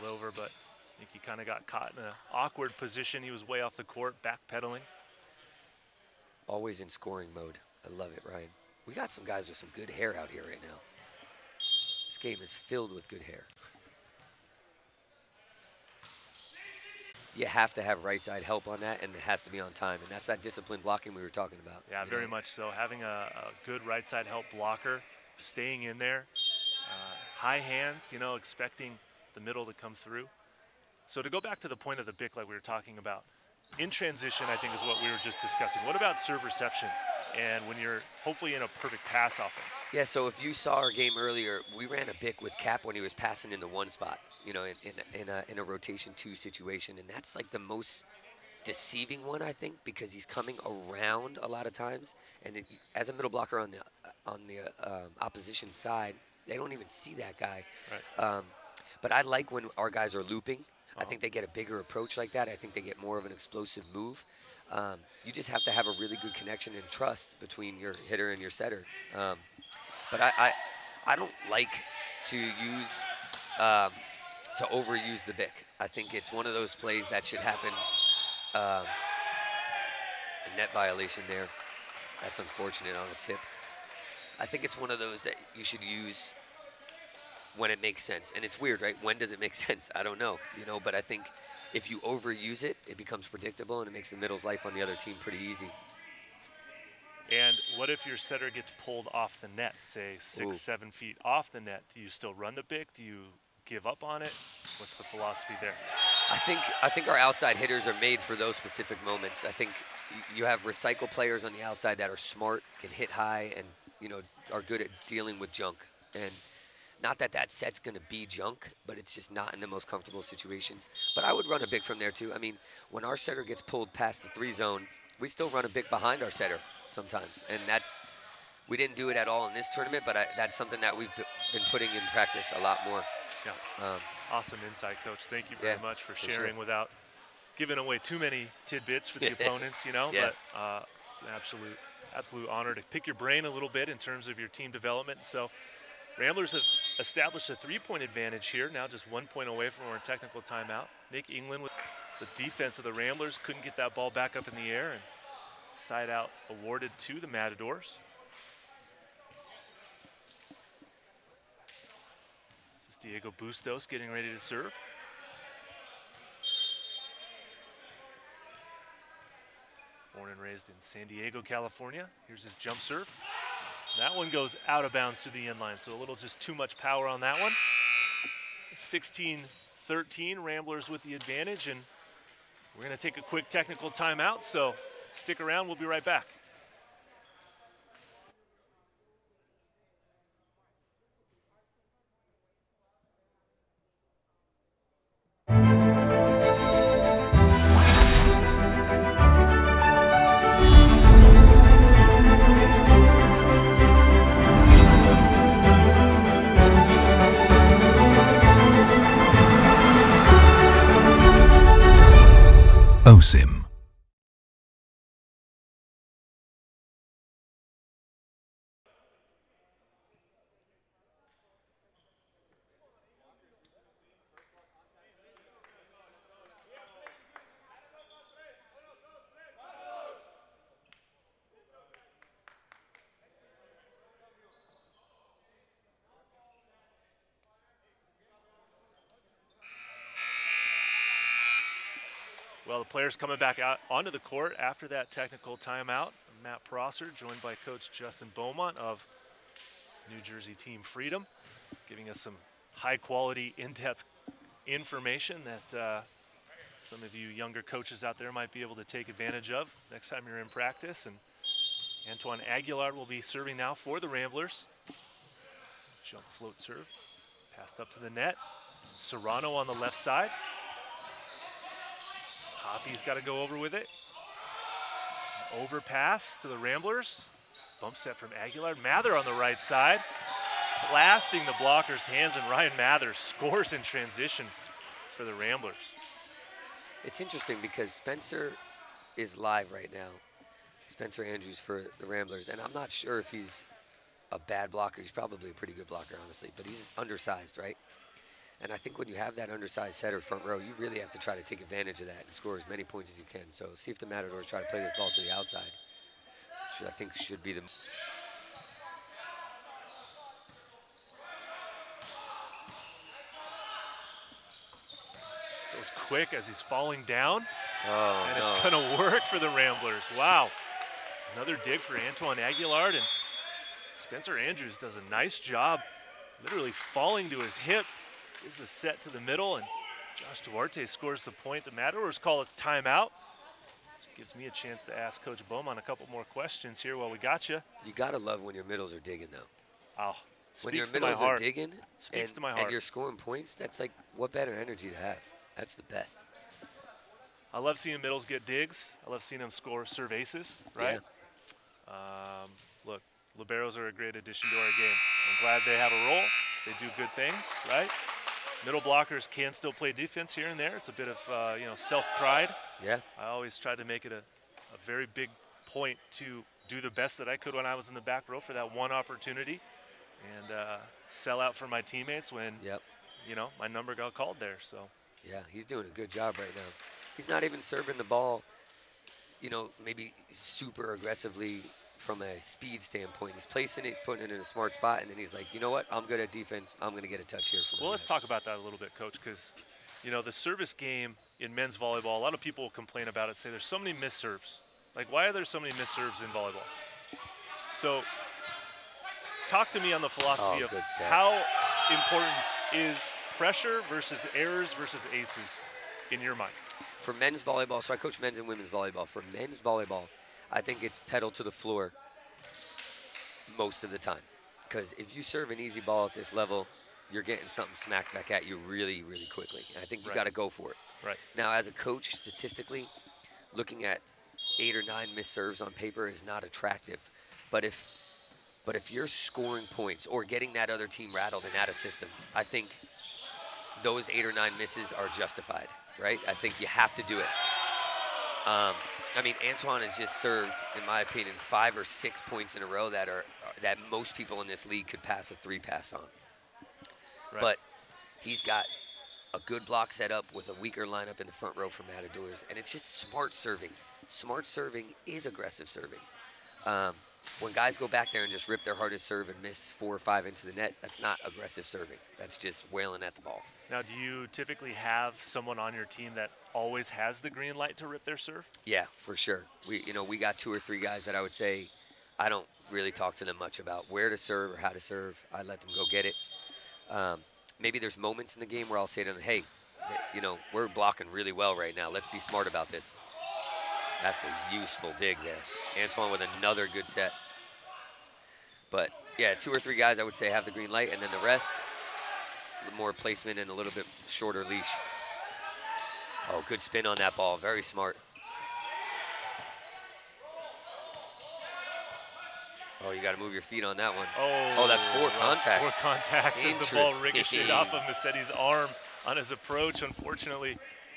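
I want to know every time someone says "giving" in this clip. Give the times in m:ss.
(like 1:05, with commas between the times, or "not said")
2:17, 4:11.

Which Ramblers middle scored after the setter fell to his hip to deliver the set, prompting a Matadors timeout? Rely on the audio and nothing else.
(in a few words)
Josh Duarte.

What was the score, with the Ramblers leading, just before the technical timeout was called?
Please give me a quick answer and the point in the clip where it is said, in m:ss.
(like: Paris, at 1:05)
16-13, at 2:58.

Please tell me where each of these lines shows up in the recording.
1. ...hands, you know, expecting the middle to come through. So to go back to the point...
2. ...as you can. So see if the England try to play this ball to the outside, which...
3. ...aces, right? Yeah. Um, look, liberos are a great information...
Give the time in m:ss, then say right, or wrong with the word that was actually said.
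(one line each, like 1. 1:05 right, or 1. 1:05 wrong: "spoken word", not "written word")
1. 0:27 right
2. 5:03 wrong: "Matadors", not "England"
3. 5:50 wrong: "addition", not "information".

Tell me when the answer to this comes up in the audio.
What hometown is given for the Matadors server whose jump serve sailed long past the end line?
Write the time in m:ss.
2:50.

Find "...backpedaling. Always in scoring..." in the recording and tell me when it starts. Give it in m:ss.
0:04.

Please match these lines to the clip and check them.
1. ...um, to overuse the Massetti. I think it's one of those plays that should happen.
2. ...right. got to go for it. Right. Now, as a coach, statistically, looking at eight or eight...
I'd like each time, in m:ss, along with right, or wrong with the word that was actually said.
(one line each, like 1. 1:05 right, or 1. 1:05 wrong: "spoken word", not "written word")
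1. 1:13 wrong: "BIC", not "Massetti"
2. 7:00 wrong: "nine", not "eight".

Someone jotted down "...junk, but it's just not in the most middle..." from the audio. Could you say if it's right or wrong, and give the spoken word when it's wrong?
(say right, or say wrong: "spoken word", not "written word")
wrong: "comfortable", not "middle".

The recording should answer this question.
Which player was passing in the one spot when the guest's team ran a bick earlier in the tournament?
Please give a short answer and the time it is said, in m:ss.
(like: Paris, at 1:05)
Cap, at 0:42.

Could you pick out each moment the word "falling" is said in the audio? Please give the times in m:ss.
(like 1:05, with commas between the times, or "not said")
5:16, 5:26.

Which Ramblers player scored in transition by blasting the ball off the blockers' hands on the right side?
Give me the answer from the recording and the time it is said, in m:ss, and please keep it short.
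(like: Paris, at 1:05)
Ryan Mather, at 4:42.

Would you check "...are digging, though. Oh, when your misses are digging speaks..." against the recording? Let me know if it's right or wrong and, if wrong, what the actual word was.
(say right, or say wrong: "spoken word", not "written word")
wrong: "middles", not "misses".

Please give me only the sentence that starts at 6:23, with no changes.
He's placing it, putting it in a smart spot, and then he's like, you know what?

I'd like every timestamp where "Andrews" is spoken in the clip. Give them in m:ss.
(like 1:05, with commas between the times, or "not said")
4:51, 5:24.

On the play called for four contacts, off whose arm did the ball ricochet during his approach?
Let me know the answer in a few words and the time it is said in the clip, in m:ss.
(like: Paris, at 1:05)
Massetti, at 8:27.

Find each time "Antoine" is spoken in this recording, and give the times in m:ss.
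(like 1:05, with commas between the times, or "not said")
4:22, 5:22, 7:19, 8:05.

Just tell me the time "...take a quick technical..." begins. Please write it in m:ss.
3:02.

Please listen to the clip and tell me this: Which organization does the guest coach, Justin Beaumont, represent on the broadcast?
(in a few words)
New Jersey Team Freedom.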